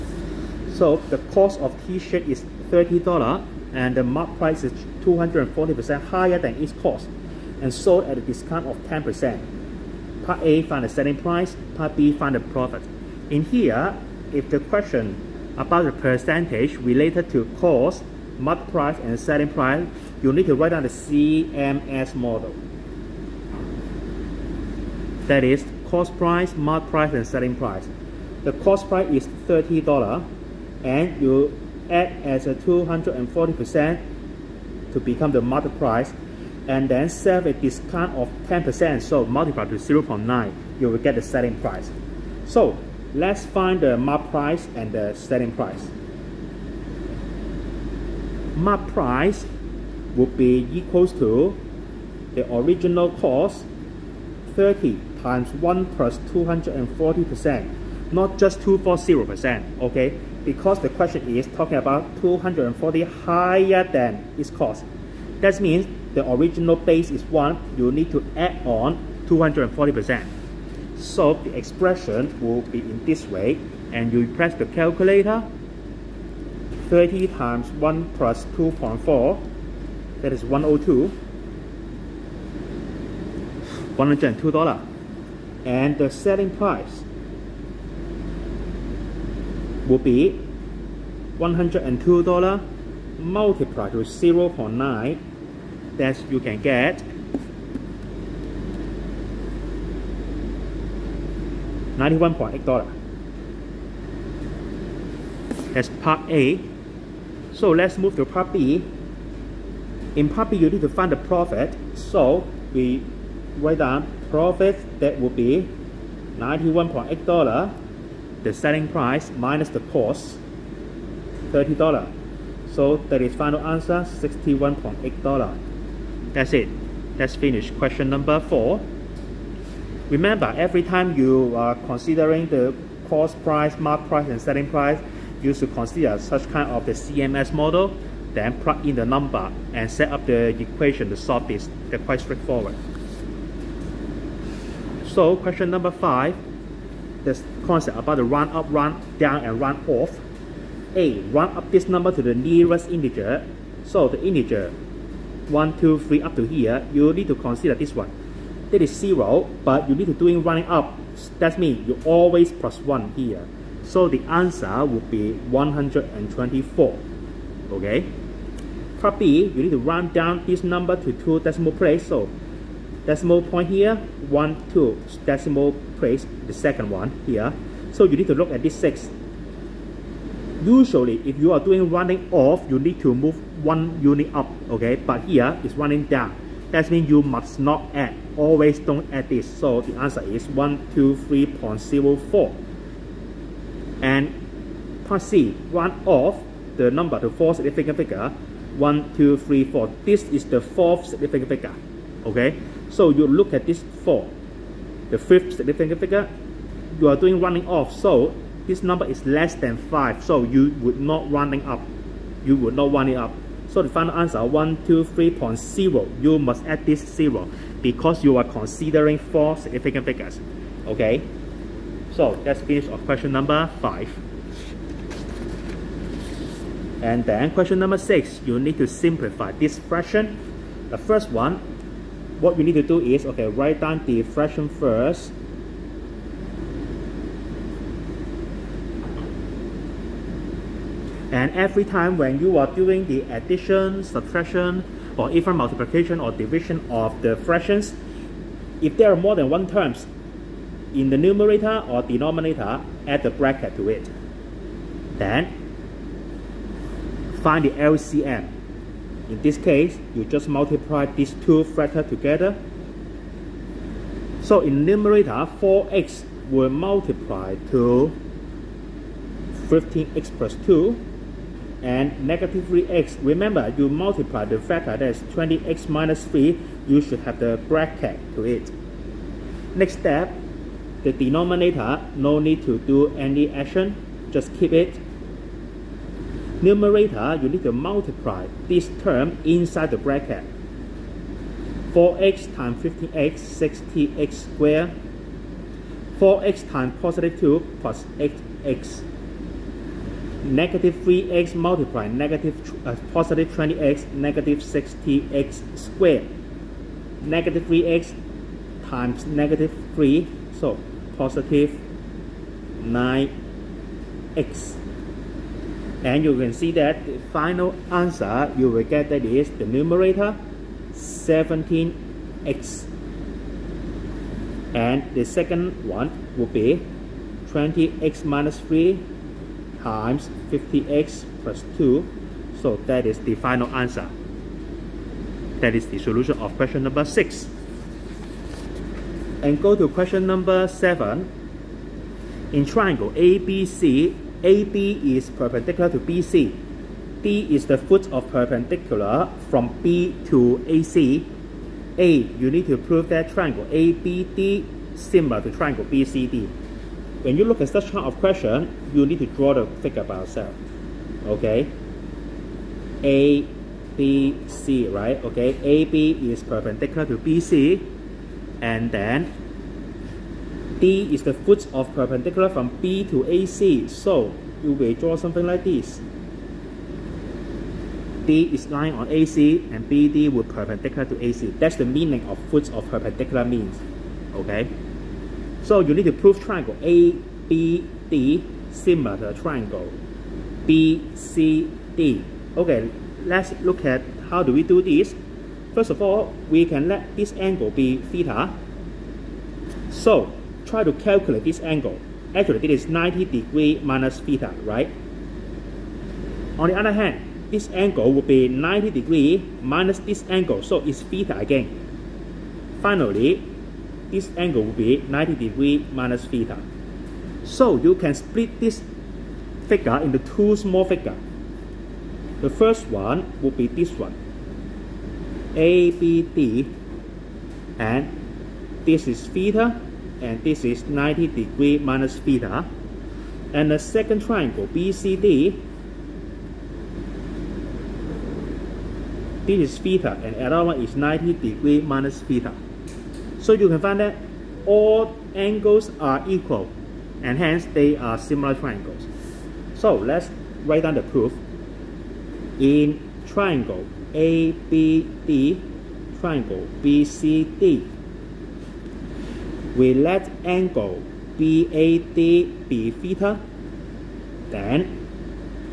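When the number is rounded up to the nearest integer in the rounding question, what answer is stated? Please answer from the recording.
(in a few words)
124.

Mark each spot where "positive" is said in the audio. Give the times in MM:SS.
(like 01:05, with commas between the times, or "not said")
04:57, 05:03, 05:11.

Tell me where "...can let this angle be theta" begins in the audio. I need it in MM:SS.
06:36.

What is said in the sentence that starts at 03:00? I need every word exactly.
Usually, if you are doing running off, you need to move one unit up, okay?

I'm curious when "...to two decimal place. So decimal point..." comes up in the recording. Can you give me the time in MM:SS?
02:50.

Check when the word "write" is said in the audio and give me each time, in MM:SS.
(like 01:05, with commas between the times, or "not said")
00:20, 01:53, 03:53, 07:30.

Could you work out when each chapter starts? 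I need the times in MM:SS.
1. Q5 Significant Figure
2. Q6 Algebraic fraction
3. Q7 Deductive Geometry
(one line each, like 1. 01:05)
1. 02:24
2. 03:48
3. 05:40.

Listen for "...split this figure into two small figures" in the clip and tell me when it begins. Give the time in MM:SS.
06:58.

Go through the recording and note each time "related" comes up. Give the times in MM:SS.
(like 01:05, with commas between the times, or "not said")
00:16.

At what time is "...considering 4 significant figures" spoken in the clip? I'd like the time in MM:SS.
03:38.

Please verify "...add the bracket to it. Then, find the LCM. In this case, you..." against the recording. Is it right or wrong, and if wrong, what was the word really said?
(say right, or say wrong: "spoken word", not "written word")
right.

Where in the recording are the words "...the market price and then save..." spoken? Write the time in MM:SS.
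00:35.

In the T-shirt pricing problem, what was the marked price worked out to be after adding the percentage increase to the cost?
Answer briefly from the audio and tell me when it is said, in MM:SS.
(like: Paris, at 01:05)
$102, at 01:20.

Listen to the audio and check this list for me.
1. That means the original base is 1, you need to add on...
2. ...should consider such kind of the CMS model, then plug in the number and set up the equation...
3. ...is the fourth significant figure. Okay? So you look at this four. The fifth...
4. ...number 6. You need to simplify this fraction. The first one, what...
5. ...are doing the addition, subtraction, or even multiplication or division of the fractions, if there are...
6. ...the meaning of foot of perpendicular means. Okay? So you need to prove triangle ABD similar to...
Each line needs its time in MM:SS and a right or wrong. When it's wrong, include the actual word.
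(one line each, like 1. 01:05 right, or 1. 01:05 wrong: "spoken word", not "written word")
1. 01:05 right
2. 02:15 right
3. 03:20 right
4. 03:47 right
5. 04:02 right
6. 06:21 right.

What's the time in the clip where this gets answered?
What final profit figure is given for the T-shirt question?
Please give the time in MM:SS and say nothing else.
02:04.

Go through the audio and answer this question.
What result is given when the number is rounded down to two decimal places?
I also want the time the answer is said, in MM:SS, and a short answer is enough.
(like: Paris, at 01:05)
123.04, at 03:10.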